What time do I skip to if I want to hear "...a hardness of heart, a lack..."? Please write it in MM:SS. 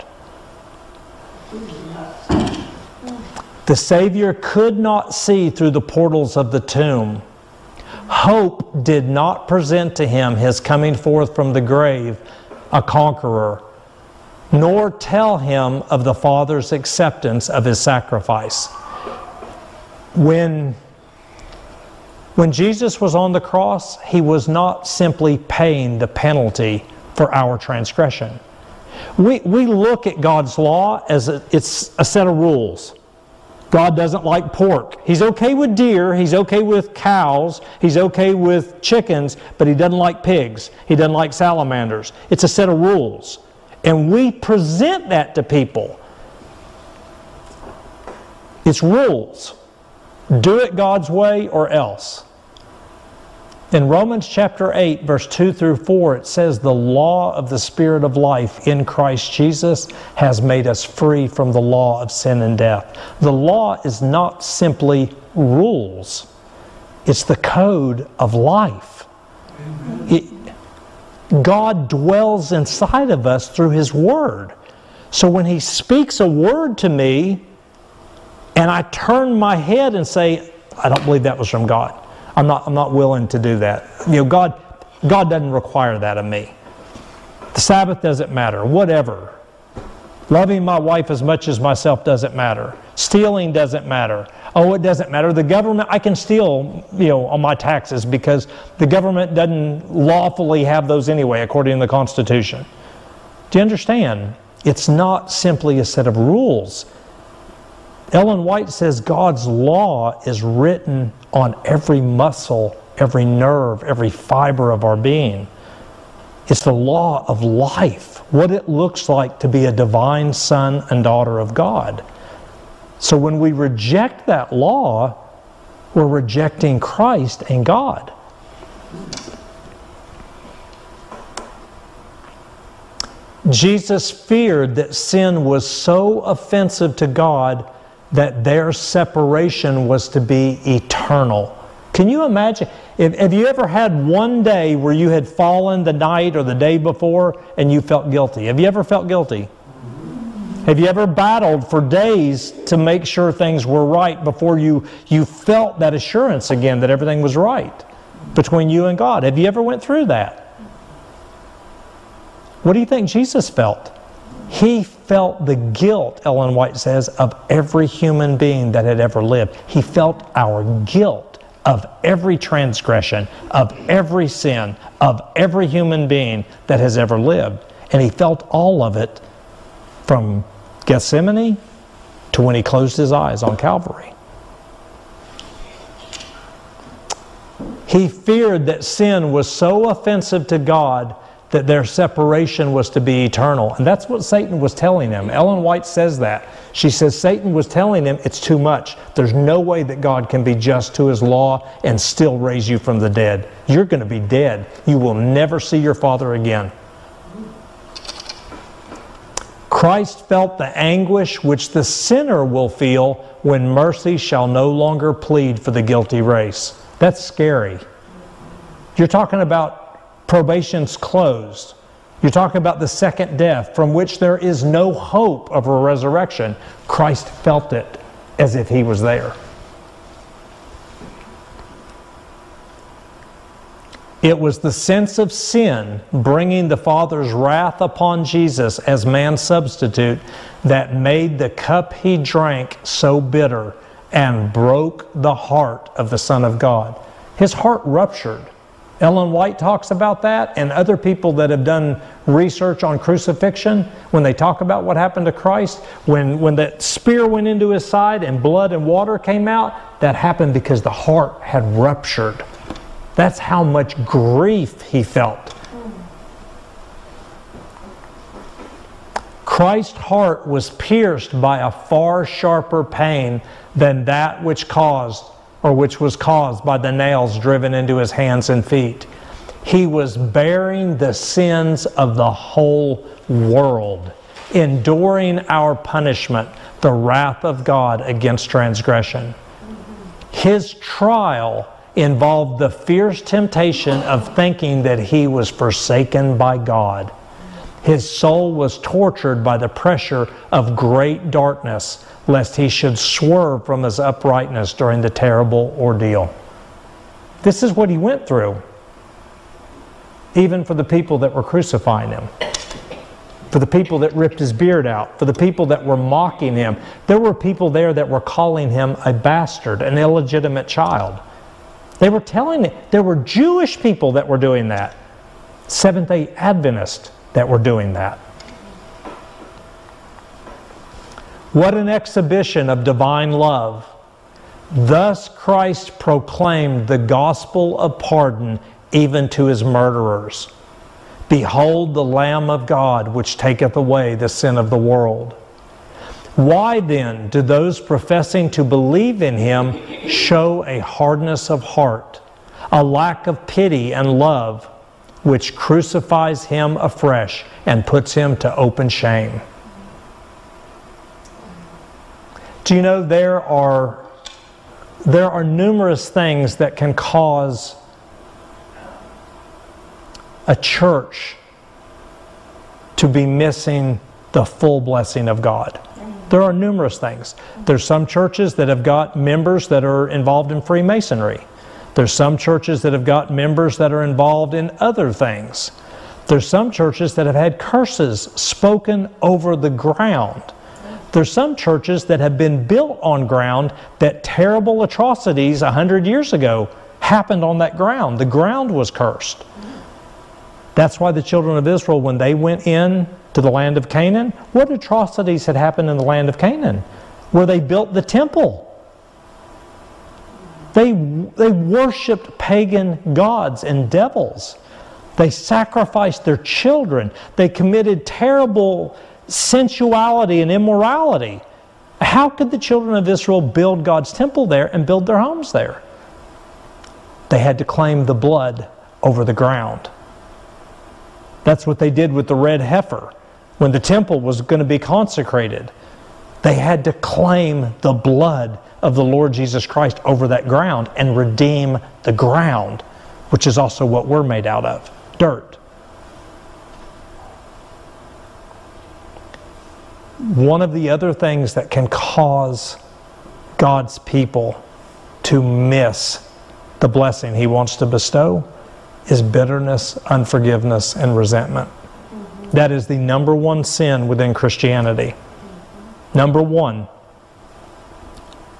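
05:50.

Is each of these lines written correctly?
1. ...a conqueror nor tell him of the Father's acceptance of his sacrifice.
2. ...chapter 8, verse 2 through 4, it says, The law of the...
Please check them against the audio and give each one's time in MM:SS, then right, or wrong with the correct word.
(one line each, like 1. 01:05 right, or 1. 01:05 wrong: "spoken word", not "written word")
1. 00:12 right
2. 00:54 right.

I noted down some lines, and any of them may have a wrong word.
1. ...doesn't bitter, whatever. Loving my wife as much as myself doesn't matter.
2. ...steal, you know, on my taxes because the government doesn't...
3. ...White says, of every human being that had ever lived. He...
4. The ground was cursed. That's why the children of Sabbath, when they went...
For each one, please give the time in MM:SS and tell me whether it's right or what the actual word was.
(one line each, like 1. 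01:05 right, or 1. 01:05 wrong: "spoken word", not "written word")
1. 01:28 wrong: "matter", not "bitter"
2. 01:36 right
3. 02:46 right
4. 06:38 wrong: "Israel", not "Sabbath".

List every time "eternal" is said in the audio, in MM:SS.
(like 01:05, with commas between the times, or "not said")
02:20, 03:13.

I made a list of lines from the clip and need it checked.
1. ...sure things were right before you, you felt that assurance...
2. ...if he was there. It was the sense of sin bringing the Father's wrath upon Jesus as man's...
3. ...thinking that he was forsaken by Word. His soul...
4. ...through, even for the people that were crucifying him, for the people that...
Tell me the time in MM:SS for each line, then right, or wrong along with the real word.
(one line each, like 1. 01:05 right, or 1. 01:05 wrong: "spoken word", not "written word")
1. 02:33 right
2. 03:48 right
3. 04:54 wrong: "God", not "Word"
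4. 05:08 right.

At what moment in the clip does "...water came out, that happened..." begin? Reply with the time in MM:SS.
04:18.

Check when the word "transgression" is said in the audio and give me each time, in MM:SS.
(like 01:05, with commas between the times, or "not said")
00:27, 02:52, 04:48.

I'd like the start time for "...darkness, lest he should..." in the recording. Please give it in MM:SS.
05:01.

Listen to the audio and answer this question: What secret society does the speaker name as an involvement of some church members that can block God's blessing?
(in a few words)
Freemasonry.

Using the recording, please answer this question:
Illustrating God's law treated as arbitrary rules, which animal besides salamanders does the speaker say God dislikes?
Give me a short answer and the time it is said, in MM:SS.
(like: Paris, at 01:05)
Pigs, at 00:39.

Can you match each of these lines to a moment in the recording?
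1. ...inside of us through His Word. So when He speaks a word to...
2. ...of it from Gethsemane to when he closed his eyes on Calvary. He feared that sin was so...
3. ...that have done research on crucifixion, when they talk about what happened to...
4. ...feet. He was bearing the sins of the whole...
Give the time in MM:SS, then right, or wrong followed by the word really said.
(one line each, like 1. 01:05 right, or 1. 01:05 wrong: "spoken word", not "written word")
1. 01:12 right
2. 02:58 right
3. 04:11 right
4. 04:38 right.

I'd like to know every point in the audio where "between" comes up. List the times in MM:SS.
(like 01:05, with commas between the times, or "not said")
02:38.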